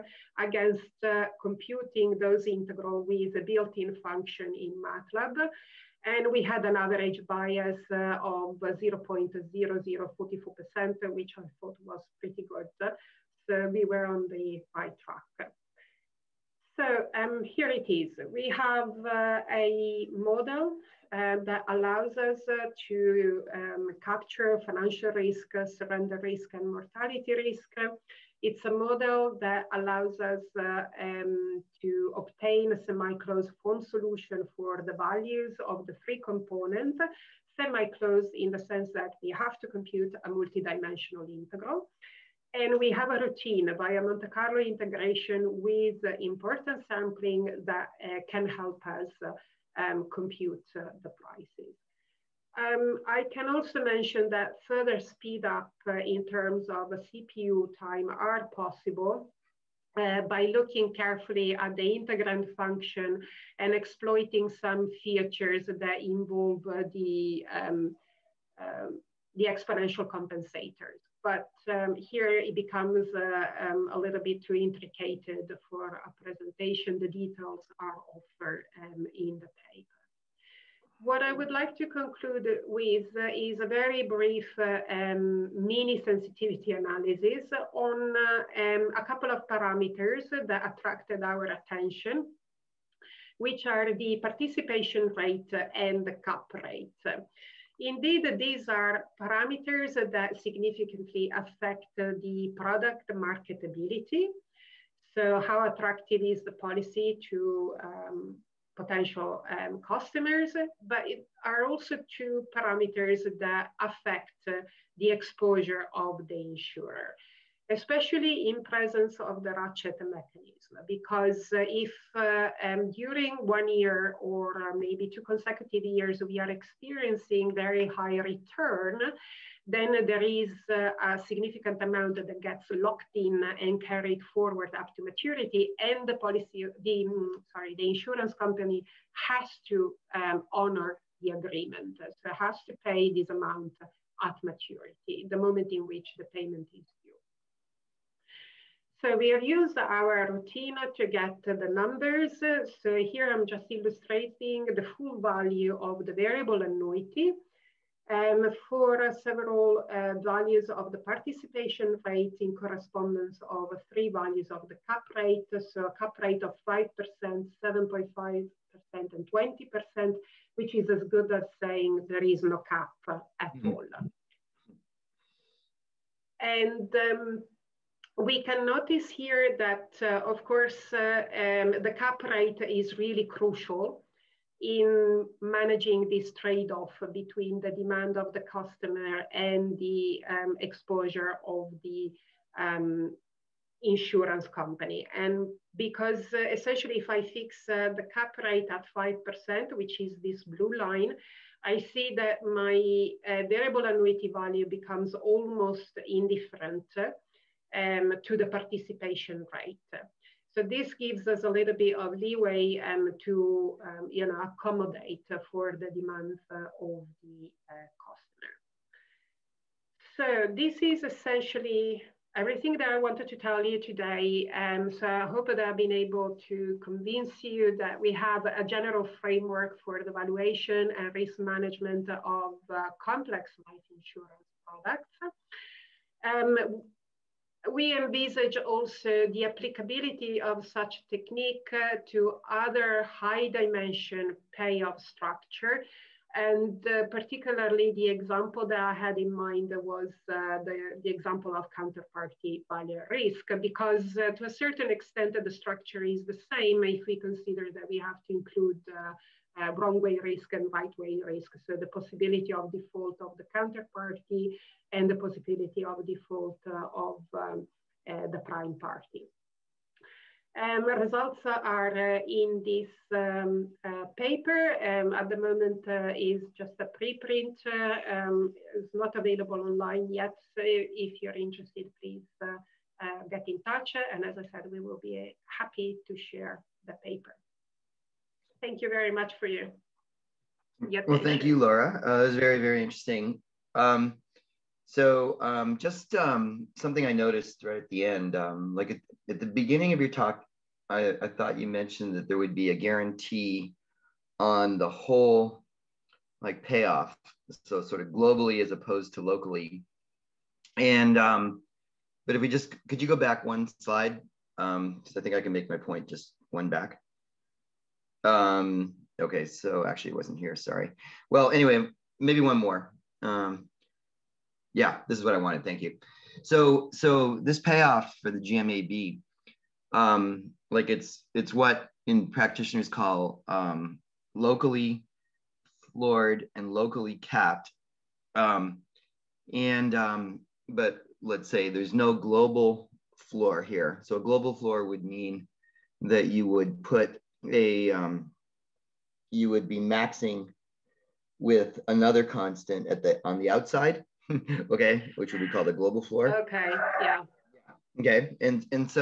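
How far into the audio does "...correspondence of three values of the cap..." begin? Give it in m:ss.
2:42.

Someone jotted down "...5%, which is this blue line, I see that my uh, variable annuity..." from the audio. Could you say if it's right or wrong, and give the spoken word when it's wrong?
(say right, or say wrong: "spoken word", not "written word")
right.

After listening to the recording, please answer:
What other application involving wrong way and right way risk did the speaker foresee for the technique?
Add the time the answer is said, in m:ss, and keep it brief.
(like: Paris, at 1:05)
counterparty value risk, at 4:11.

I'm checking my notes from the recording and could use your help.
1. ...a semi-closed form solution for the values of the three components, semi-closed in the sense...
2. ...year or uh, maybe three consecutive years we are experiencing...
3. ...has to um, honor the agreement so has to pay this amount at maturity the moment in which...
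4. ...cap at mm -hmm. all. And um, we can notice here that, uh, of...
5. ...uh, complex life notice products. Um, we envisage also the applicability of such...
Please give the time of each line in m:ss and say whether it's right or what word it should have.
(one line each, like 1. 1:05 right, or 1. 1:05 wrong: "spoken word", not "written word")
1. 0:32 right
2. 2:03 wrong: "two", not "three"
3. 2:19 right
4. 2:52 right
5. 3:52 wrong: "insurance", not "notice".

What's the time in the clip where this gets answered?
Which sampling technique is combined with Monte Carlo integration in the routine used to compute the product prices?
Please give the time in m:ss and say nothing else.
0:46.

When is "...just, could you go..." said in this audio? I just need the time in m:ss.
5:12.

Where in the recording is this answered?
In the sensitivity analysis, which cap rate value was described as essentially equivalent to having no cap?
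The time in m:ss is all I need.
2:49.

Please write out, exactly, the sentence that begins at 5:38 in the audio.
Um, and, um, but let's say there's no global floor here.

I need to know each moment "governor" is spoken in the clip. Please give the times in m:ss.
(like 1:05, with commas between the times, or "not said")
not said.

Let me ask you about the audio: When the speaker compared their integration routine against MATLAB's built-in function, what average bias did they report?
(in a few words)
0.0044%.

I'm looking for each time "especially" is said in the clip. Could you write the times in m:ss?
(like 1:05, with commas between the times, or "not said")
1:57.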